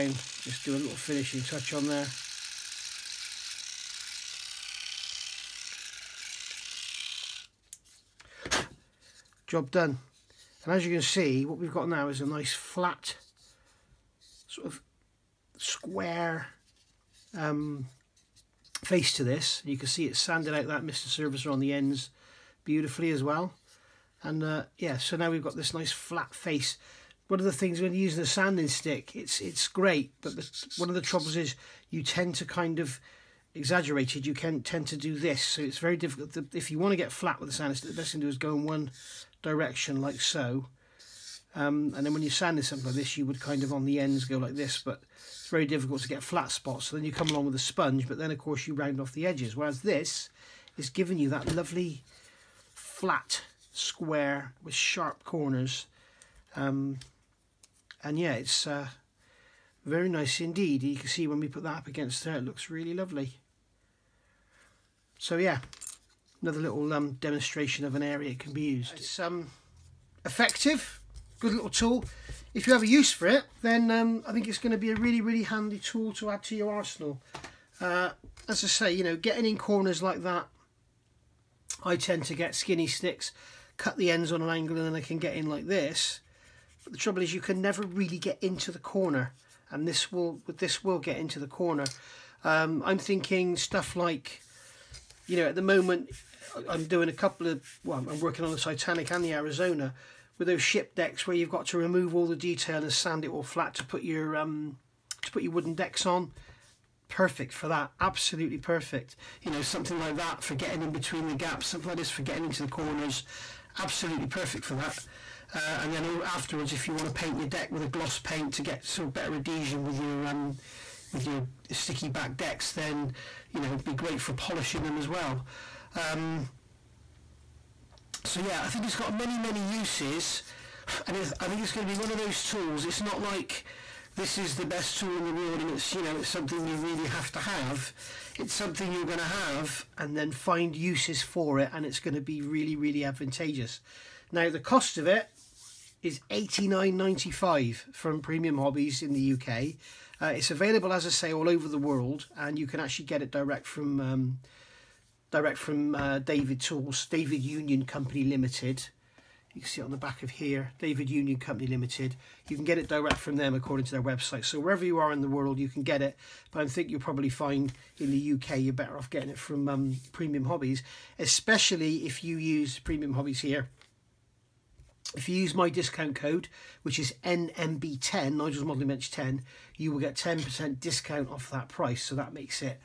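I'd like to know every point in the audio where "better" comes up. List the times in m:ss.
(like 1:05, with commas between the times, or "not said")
1:59, 2:48.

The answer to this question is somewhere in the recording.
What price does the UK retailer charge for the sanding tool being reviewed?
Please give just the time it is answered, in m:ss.
2:26.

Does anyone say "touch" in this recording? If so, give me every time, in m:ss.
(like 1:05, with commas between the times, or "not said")
0:01.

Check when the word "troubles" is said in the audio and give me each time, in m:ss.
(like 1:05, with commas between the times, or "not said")
0:31, 1:26.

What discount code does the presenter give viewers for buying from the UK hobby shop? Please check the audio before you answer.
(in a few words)
NMB10.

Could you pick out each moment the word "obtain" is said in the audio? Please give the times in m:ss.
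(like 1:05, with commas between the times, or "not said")
not said.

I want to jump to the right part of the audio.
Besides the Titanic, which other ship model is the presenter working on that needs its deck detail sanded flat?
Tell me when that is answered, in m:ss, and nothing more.
1:39.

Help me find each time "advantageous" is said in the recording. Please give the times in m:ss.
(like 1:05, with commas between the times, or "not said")
2:23.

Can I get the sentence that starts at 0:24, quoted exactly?
And uh, yeah, so now we've got this nice flat face.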